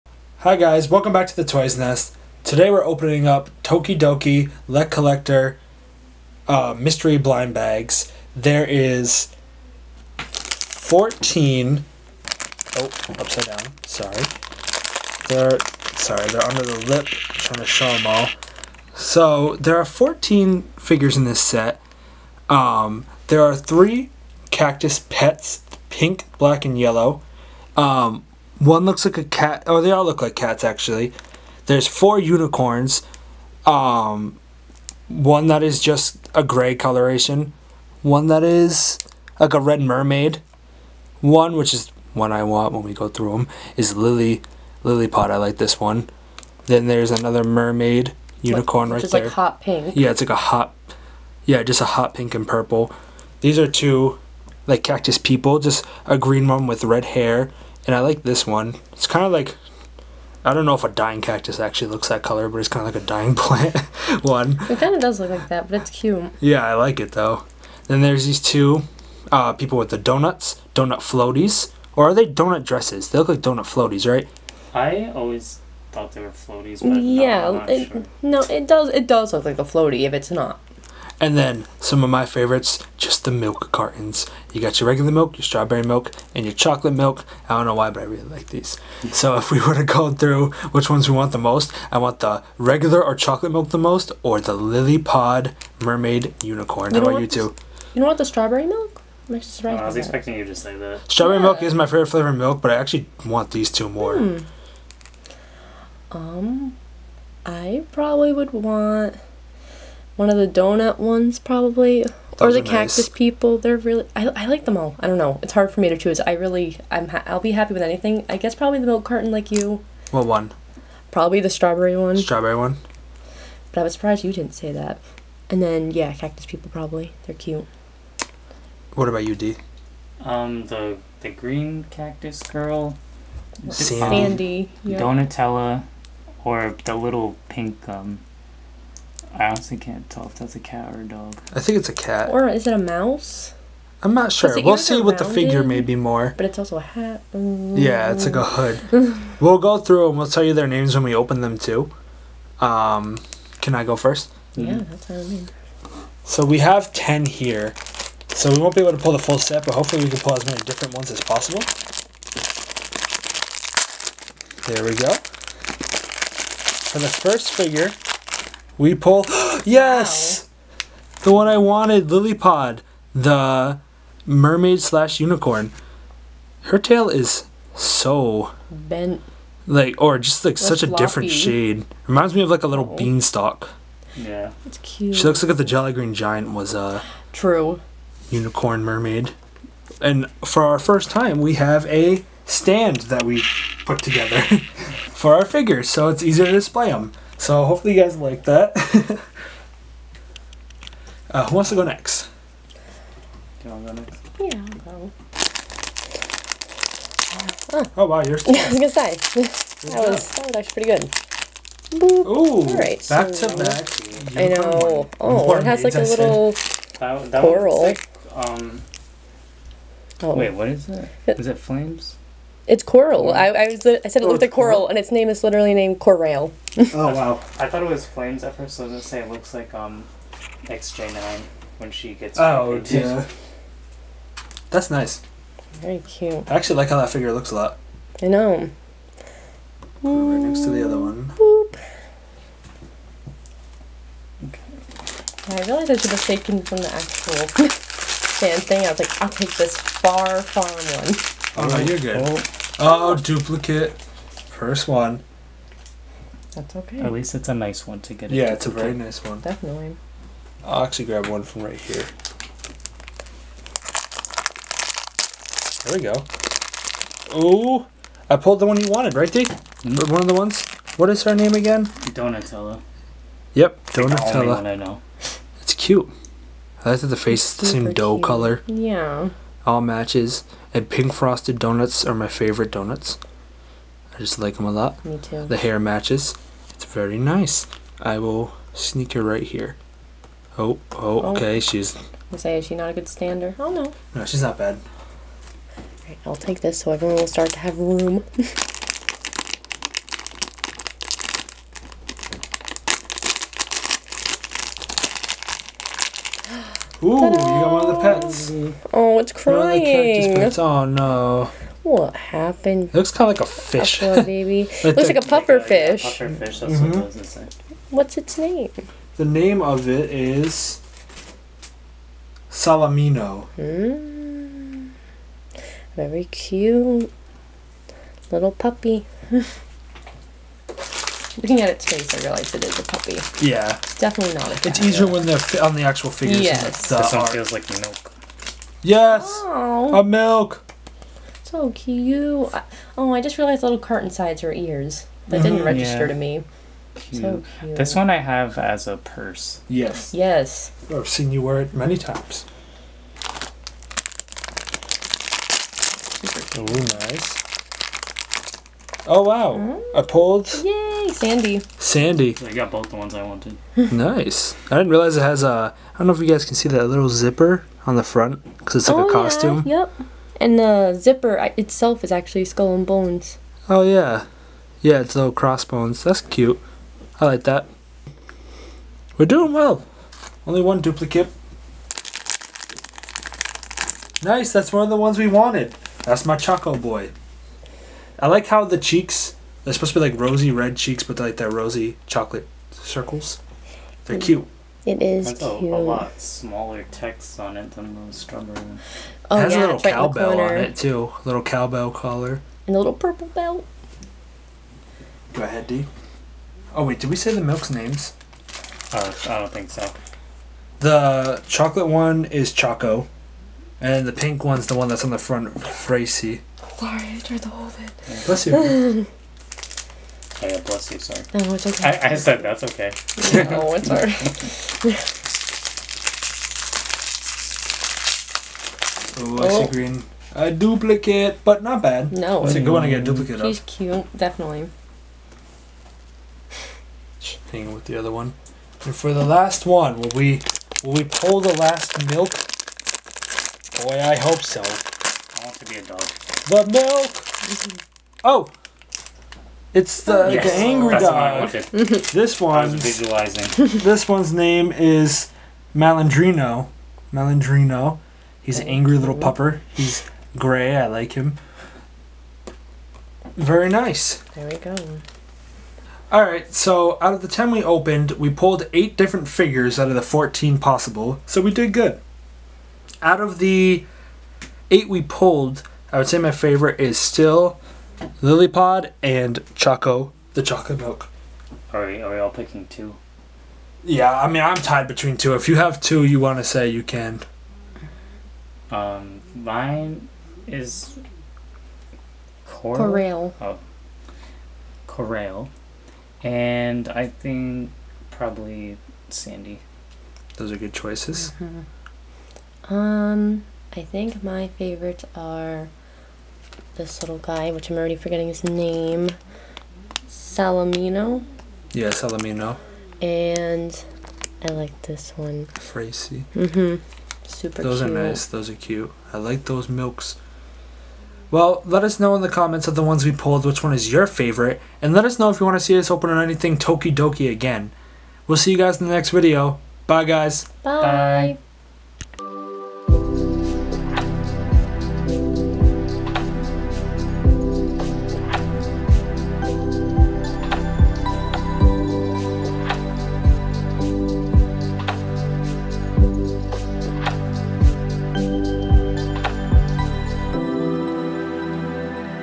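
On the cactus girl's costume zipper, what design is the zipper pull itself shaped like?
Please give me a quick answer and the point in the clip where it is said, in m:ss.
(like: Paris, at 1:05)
skull and bones, at 6:12.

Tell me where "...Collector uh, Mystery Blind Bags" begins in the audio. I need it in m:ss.
0:04.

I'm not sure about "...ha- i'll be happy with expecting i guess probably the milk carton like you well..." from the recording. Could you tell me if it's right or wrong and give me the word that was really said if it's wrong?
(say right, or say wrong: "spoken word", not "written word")
wrong: "anything", not "expecting".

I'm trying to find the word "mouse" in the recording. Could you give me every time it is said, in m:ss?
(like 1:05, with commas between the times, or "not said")
2:22.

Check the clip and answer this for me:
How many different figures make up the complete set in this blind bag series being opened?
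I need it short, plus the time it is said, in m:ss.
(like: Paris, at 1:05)
14, at 0:19.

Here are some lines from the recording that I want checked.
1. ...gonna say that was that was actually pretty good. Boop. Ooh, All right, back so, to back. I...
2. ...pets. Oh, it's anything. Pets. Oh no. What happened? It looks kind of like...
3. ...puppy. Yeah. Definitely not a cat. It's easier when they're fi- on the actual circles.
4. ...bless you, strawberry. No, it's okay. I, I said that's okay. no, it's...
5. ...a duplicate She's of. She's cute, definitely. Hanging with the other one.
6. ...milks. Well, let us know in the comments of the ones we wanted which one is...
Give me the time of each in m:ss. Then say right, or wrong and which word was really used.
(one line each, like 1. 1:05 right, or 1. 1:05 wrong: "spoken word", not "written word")
1. 3:28 right
2. 5:07 wrong: "crying", not "anything"
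3. 5:32 wrong: "figures", not "circles"
4. 7:00 wrong: "sorry", not "strawberry"
5. 7:13 right
6. 8:39 wrong: "pulled", not "wanted".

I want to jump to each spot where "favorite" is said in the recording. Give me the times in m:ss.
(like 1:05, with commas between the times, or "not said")
1:22, 1:41, 4:42, 7:56, 8:24, 8:44.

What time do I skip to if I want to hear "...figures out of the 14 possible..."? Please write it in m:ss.
7:49.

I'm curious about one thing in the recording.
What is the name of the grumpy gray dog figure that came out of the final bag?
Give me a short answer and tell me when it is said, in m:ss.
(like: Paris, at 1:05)
Malandrino, at 7:33.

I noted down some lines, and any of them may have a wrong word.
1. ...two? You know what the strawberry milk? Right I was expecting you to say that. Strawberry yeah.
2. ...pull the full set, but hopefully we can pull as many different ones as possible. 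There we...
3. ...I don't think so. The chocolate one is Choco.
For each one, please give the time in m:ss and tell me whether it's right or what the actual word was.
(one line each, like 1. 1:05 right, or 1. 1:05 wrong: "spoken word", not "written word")
1. 1:37 right
2. 2:38 right
3. 6:49 right.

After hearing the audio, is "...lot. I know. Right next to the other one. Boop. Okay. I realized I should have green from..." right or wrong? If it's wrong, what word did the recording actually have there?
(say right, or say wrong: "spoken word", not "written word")
wrong: "taken", not "green".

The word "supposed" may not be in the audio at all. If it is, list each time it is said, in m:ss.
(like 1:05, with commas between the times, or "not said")
6:29.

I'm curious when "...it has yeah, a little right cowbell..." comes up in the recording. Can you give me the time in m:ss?
6:39.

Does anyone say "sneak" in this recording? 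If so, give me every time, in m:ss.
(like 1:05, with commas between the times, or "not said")
4:48.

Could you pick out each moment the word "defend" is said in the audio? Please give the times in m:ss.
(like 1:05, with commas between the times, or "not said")
not said.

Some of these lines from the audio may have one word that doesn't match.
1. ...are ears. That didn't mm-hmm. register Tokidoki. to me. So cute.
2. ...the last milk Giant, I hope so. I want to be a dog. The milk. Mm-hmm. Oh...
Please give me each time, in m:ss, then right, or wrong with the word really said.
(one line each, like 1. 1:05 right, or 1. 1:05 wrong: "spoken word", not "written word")
1. 5:44 wrong: "Yeah", not "Tokidoki"
2. 7:21 wrong: "Boy", not "Giant".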